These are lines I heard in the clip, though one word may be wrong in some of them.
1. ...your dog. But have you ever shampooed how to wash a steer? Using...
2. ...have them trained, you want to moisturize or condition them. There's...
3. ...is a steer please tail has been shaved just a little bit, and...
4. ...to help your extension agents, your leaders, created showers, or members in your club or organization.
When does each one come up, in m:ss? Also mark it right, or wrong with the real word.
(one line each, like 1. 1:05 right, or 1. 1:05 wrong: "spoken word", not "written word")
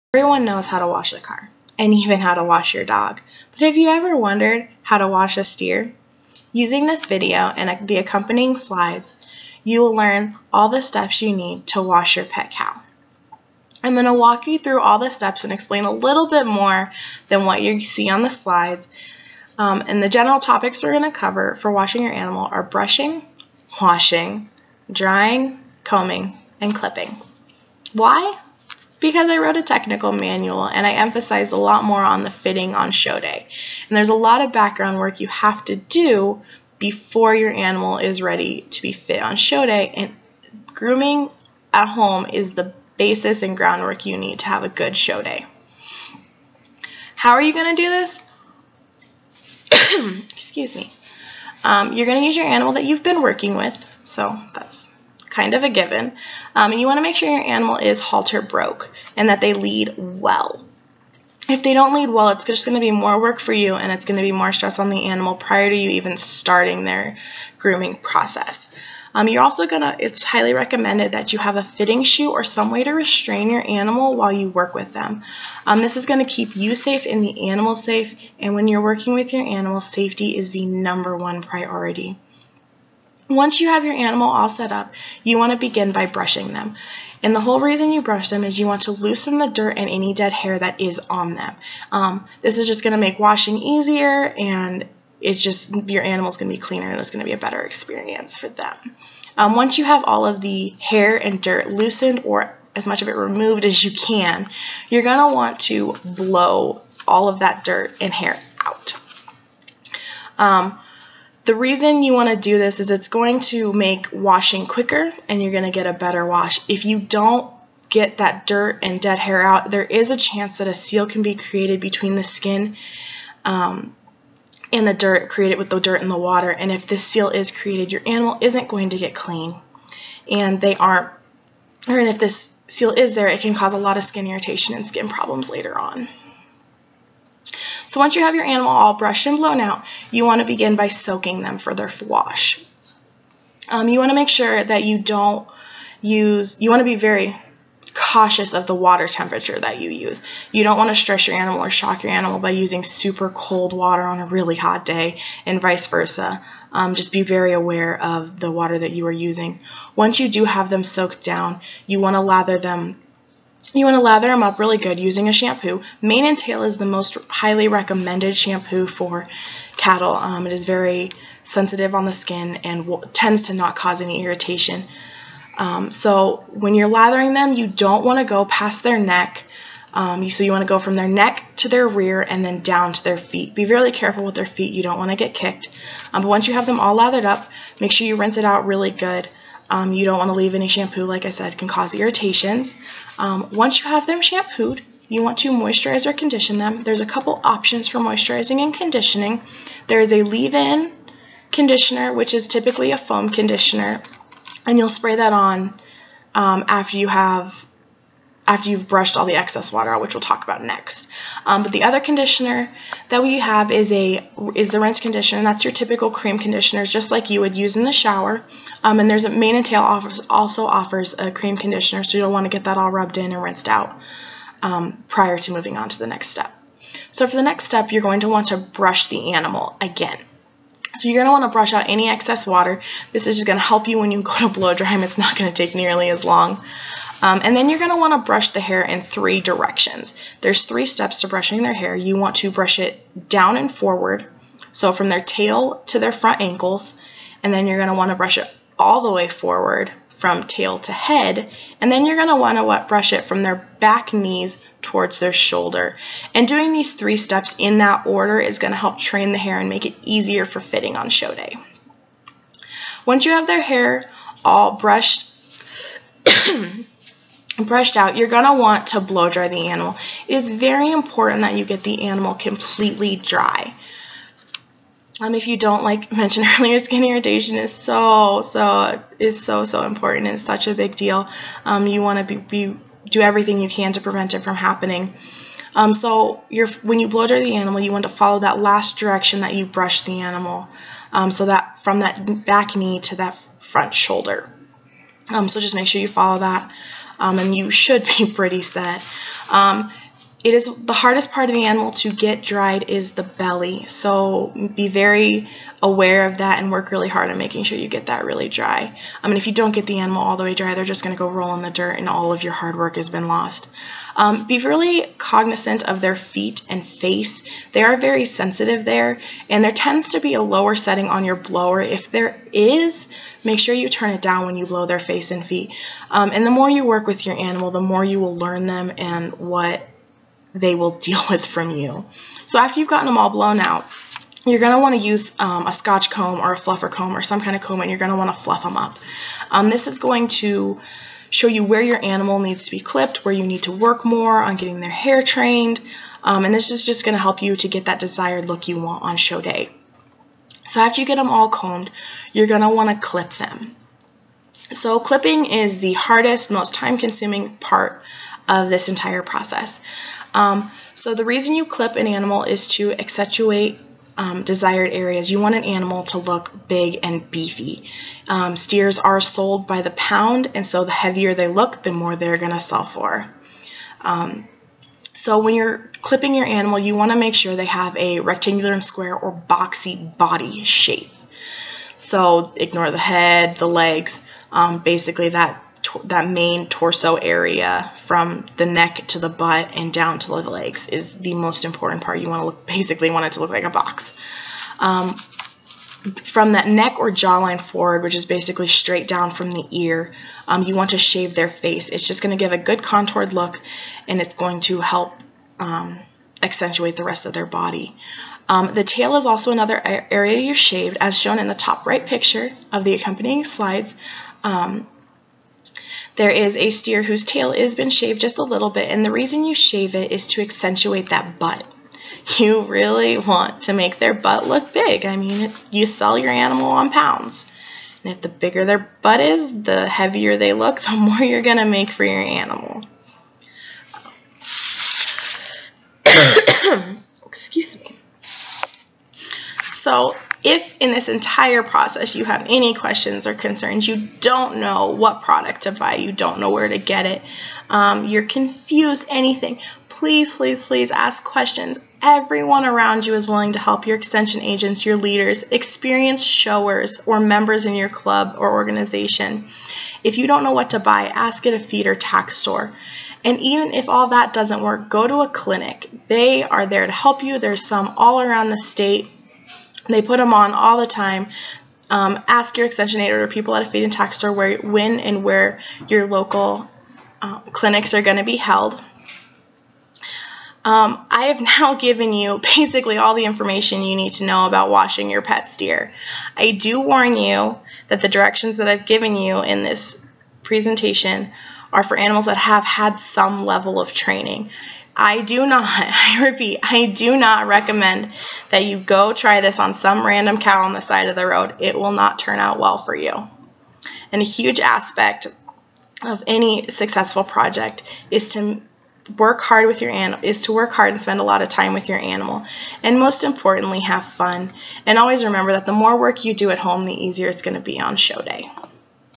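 1. 0:02 wrong: "wondered", not "shampooed"
2. 3:13 wrong: "shampooed", not "trained"
3. 6:56 wrong: "whose", not "please"
4. 7:33 wrong: "experienced", not "created".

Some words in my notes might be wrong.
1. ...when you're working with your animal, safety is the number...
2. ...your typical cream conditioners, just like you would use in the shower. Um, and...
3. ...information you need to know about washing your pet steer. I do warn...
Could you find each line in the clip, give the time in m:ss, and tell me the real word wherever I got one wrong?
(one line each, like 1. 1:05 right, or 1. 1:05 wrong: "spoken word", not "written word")
1. 1:18 right
2. 3:35 right
3. 8:03 right.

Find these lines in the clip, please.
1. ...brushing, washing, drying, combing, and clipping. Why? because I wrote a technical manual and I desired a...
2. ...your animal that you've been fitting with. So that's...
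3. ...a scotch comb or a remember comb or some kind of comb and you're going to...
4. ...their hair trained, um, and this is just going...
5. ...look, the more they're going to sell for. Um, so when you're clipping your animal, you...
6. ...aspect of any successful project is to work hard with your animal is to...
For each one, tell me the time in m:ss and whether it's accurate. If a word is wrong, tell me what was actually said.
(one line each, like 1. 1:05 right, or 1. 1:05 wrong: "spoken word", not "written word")
1. 0:22 wrong: "emphasized", not "desired"
2. 0:52 wrong: "working", not "fitting"
3. 5:35 wrong: "fluffer", not "remember"
4. 5:44 right
5. 6:11 right
6. 8:24 right.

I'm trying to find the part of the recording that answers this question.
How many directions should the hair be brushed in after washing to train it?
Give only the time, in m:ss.
3:59.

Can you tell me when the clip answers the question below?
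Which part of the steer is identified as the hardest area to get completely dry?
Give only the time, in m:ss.
5:03.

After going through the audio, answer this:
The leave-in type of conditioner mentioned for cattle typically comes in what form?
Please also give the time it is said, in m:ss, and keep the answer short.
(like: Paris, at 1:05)
Foam, at 3:22.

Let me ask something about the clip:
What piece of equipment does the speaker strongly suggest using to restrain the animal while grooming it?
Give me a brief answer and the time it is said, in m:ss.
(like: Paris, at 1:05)
Fitting chute, at 1:11.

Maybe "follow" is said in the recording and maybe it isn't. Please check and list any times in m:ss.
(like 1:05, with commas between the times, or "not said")
4:48, 4:56.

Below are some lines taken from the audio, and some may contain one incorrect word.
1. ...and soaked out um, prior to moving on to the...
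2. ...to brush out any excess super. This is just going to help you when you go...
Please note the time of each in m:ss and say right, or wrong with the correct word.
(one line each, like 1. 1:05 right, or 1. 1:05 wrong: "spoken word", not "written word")
1. 3:43 wrong: "rinsed", not "soaked"
2. 3:51 wrong: "water", not "super".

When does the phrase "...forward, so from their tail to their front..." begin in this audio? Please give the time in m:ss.
4:03.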